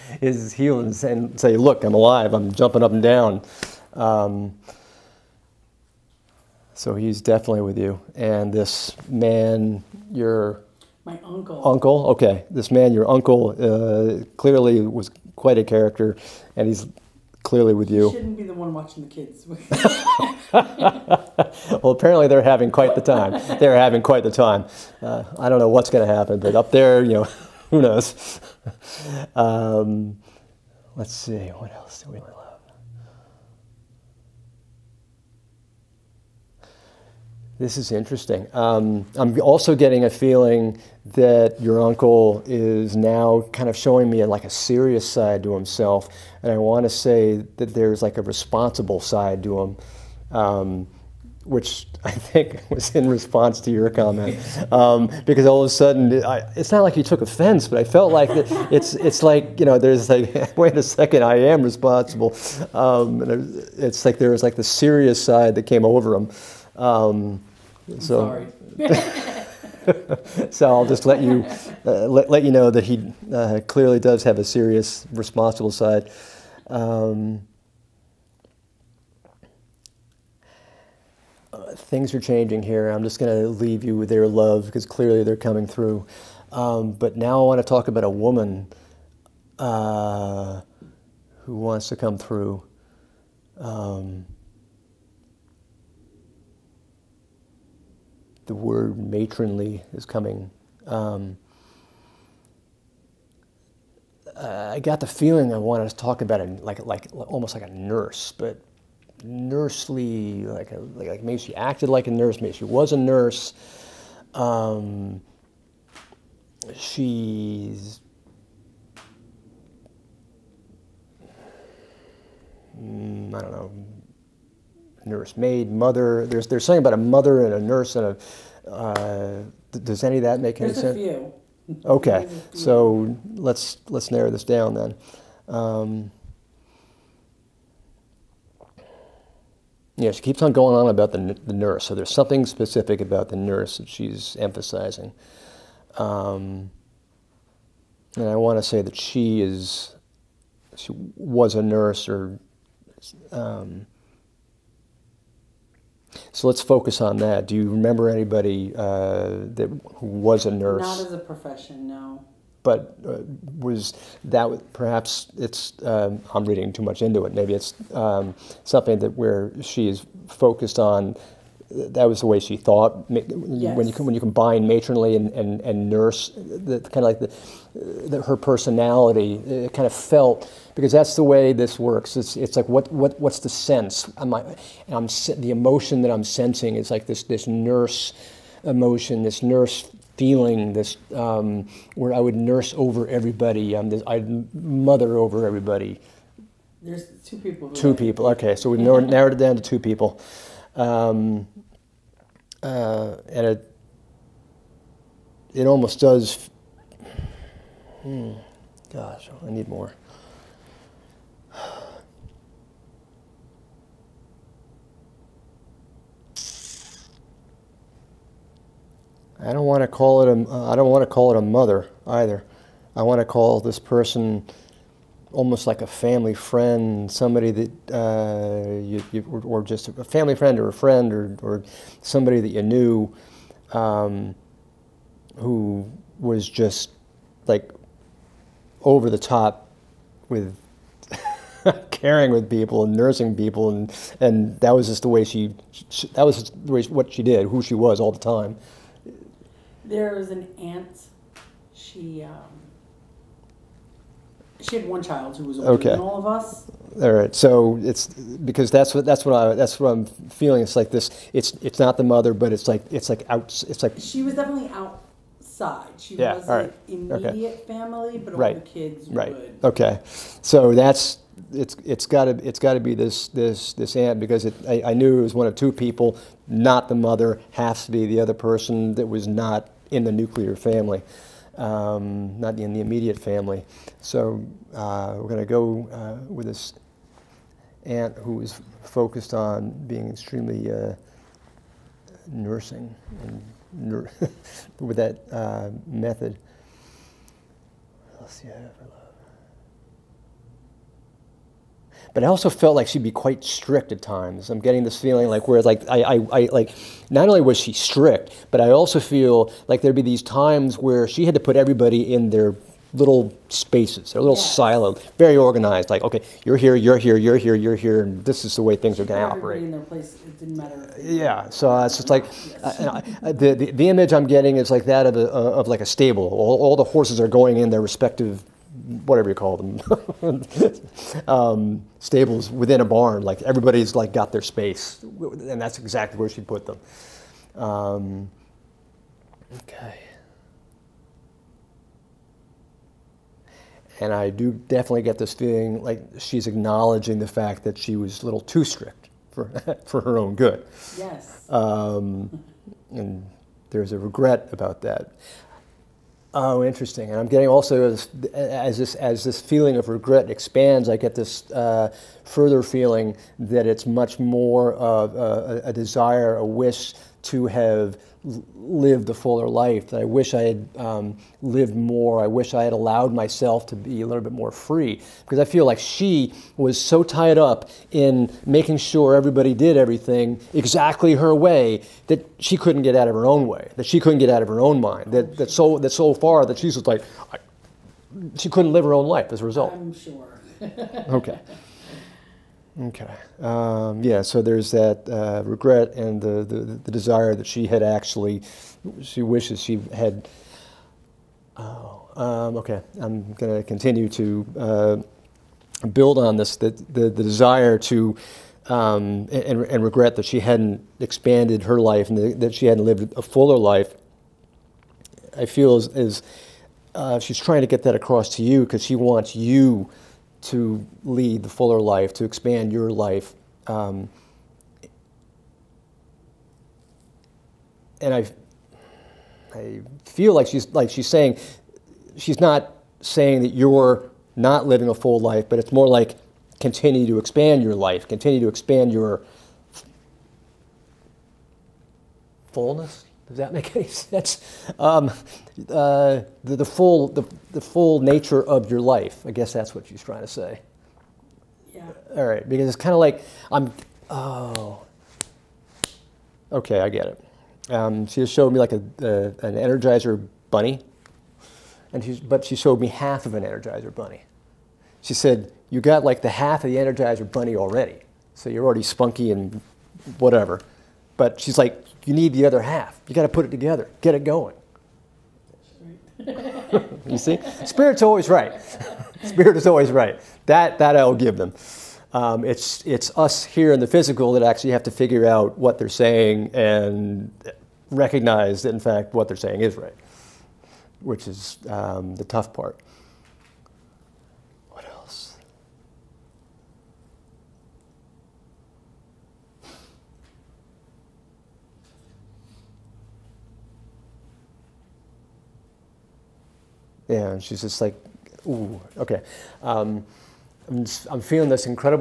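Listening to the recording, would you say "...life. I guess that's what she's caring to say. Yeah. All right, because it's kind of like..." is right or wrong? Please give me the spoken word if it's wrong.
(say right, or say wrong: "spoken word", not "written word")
wrong: "trying", not "caring".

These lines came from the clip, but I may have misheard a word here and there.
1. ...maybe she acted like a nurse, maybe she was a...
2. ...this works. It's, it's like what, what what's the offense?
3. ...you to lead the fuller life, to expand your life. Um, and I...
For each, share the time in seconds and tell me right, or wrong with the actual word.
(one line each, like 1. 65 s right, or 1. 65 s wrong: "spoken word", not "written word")
1. 111 s right
2. 181 s wrong: "sense", not "offense"
3. 419 s right.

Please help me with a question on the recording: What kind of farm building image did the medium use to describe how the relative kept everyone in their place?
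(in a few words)
A stable.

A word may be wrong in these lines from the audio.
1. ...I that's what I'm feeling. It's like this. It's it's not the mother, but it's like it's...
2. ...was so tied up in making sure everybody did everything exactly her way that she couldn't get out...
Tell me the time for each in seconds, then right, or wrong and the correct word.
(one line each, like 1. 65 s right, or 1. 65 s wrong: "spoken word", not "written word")
1. 259 s right
2. 376 s right.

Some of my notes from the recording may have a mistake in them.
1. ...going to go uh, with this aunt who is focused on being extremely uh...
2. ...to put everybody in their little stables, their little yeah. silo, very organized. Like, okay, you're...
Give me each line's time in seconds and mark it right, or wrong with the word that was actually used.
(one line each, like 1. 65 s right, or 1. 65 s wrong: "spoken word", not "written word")
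1. 285 s right
2. 311 s wrong: "spaces", not "stables".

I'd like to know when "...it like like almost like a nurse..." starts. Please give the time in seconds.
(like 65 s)
106 s.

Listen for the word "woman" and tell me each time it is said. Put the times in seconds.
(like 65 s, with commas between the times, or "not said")
88 s.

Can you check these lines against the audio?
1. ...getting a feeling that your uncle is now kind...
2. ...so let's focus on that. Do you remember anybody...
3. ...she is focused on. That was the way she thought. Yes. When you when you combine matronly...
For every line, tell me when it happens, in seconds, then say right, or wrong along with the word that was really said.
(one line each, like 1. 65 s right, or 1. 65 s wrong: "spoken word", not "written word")
1. 39 s right
2. 156 s right
3. 169 s right.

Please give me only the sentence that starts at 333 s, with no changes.
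Like everybody's like got their space, and that's exactly where she put them.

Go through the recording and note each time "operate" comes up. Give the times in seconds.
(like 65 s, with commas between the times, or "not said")
319 s.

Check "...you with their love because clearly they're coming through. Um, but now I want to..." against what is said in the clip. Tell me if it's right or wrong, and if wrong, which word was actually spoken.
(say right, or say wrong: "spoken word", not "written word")
right.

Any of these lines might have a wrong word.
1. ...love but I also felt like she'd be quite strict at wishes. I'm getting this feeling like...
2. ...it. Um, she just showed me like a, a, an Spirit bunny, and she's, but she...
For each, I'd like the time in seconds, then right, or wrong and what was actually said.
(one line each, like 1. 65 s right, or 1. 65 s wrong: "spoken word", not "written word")
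1. 298 s wrong: "times", not "wishes"
2. 457 s wrong: "Energizer", not "Spirit".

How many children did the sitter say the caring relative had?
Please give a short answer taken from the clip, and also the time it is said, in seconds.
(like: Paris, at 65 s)
1, at 254 s.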